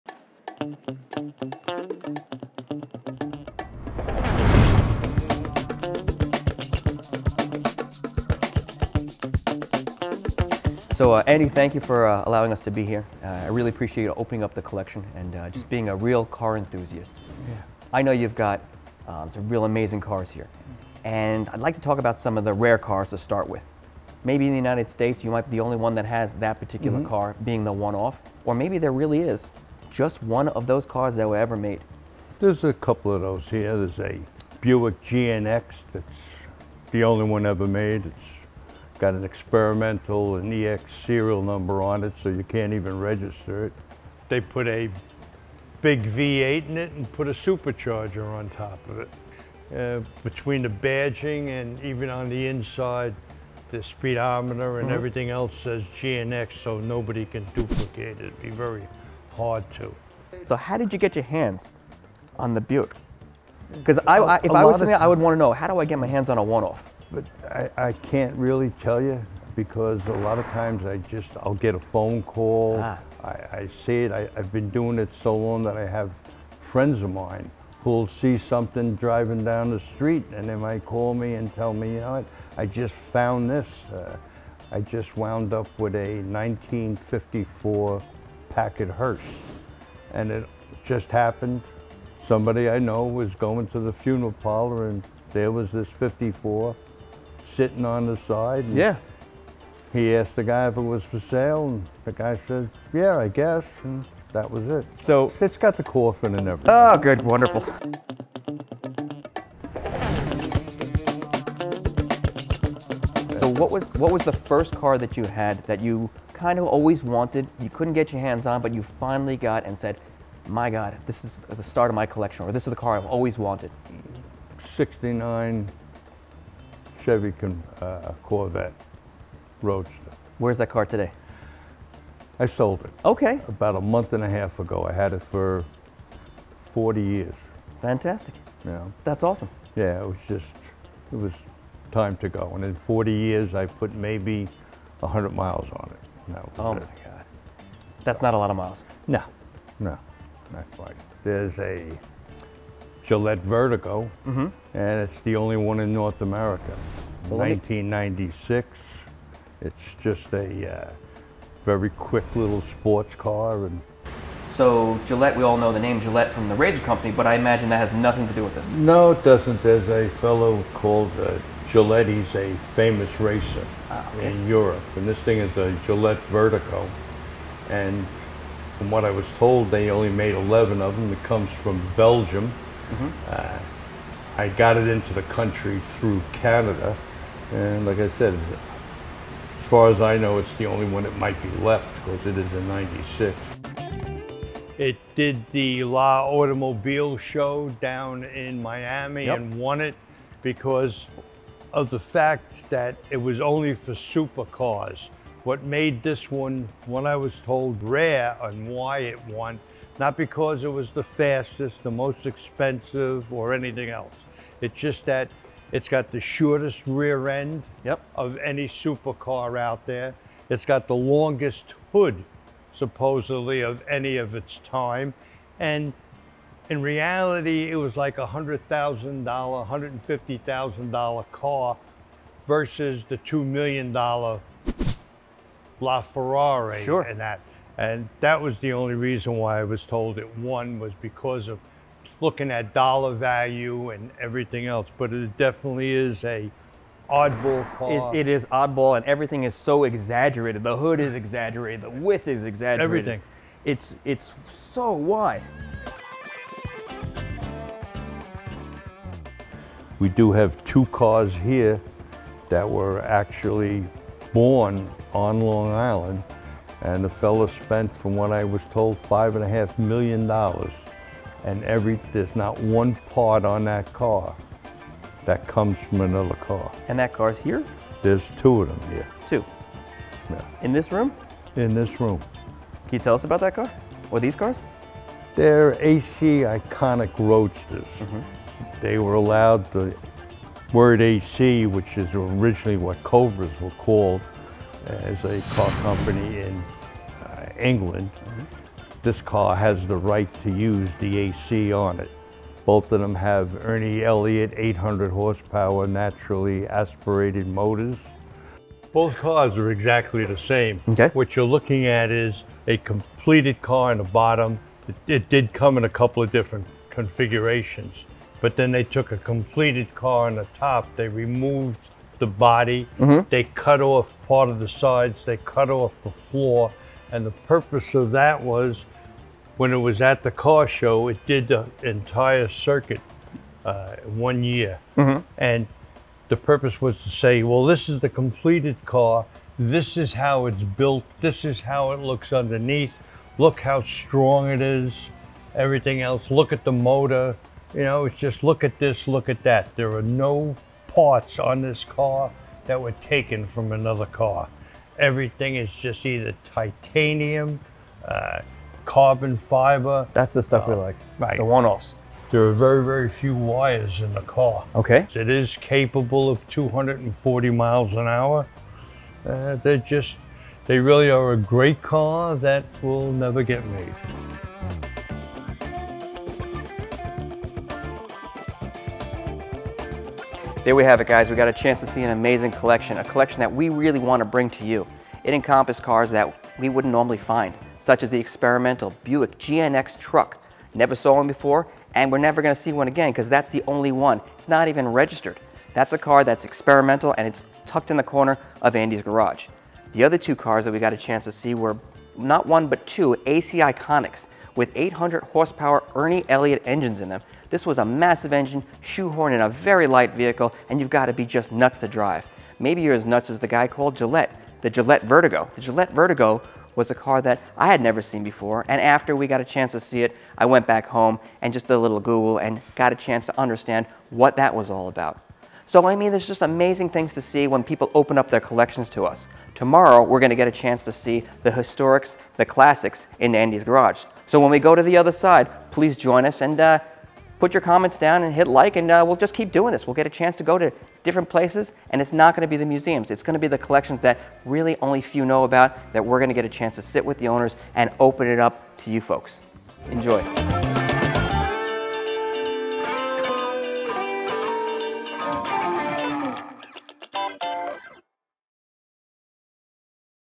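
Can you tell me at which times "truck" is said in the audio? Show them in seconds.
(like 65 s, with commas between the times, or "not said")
389 s.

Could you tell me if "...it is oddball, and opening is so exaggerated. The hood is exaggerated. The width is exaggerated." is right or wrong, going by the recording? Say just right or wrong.
wrong.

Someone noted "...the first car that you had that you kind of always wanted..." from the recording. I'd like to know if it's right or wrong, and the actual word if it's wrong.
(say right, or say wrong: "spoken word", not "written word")
right.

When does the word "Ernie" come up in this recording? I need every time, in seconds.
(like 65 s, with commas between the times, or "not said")
303 s, 405 s.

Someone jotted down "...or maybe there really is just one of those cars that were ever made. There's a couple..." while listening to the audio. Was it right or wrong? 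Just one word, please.
right.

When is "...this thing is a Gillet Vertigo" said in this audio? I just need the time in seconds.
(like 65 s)
175 s.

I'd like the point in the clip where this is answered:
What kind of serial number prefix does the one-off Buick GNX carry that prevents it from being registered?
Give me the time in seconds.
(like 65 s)
40 s.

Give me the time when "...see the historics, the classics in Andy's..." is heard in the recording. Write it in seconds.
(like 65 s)
430 s.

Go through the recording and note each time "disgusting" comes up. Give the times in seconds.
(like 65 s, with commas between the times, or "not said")
not said.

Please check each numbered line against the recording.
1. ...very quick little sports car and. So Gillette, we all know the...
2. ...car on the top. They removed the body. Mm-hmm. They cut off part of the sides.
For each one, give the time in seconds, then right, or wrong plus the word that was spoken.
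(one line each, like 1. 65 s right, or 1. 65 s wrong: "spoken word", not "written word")
1. 161 s right
2. 319 s right.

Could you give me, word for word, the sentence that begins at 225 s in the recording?
And in reality, it was like a $100,000, $150,000 car versus the $2 million LaFerrari sure.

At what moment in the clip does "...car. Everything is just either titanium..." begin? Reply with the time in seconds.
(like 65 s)
354 s.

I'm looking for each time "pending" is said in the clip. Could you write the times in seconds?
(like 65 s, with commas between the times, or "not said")
not said.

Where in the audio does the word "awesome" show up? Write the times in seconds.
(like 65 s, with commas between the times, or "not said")
139 s.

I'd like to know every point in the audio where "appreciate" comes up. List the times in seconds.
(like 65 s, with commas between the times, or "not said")
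13 s.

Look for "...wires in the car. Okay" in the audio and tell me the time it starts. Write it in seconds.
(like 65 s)
363 s.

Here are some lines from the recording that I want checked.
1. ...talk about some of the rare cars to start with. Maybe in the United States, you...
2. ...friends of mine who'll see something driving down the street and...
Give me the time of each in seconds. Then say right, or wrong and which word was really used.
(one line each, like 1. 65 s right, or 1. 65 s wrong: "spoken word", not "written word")
1. 21 s right
2. 76 s right.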